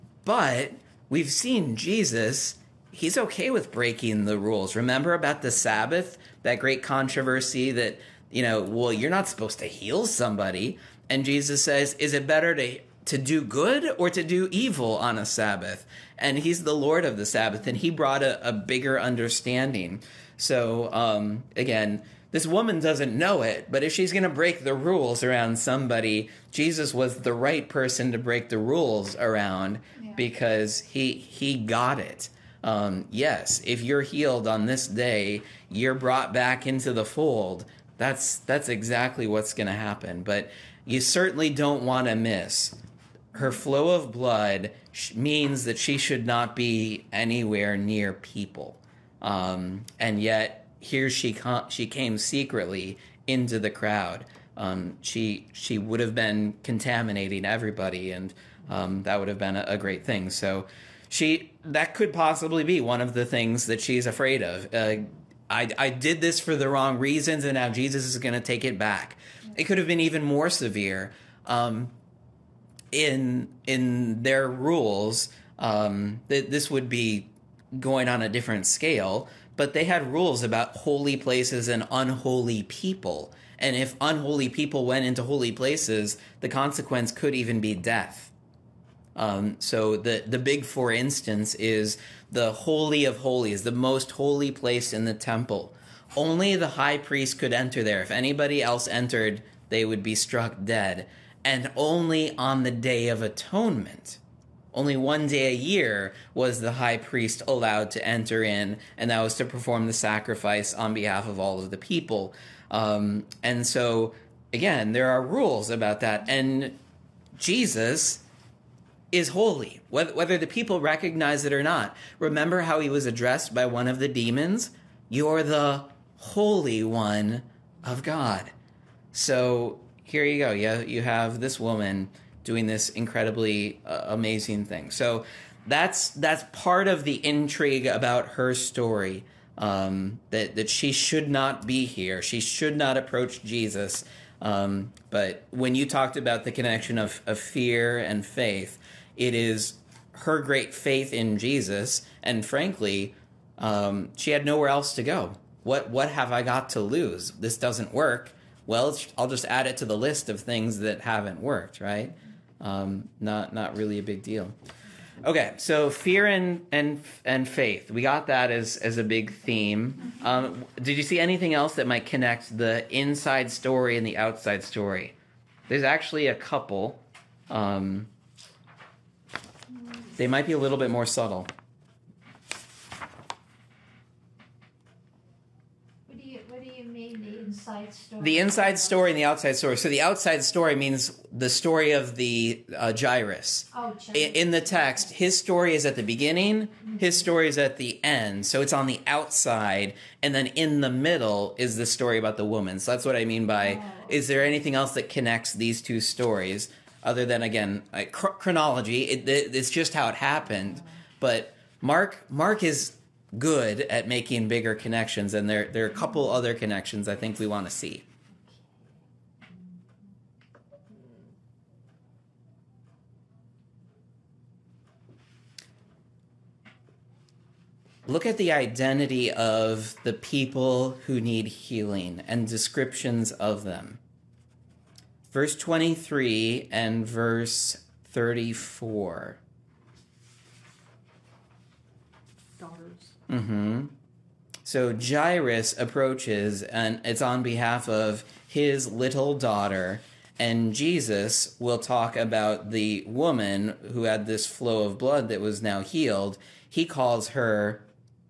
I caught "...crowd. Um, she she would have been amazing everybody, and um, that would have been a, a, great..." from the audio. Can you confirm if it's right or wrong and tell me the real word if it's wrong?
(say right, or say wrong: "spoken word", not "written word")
wrong: "contaminating", not "amazing".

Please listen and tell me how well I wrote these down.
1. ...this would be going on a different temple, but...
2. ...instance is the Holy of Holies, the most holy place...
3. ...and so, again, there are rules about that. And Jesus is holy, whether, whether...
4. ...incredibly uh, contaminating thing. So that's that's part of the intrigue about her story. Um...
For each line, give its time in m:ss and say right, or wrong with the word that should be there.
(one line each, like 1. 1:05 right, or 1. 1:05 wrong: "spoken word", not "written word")
1. 1:16 wrong: "scale", not "temple"
2. 1:30 right
3. 1:53 right
4. 2:12 wrong: "amazing", not "contaminating".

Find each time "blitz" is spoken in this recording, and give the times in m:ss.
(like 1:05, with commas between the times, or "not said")
not said.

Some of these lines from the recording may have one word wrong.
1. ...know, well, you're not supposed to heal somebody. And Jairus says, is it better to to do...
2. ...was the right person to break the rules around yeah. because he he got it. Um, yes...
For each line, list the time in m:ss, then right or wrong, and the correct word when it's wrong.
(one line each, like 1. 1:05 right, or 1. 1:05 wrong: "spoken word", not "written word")
1. 0:08 wrong: "Jesus", not "Jairus"
2. 0:26 right.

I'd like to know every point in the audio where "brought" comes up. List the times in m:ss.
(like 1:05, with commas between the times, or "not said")
0:17, 0:35.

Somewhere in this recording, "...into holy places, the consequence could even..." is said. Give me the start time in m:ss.
1:25.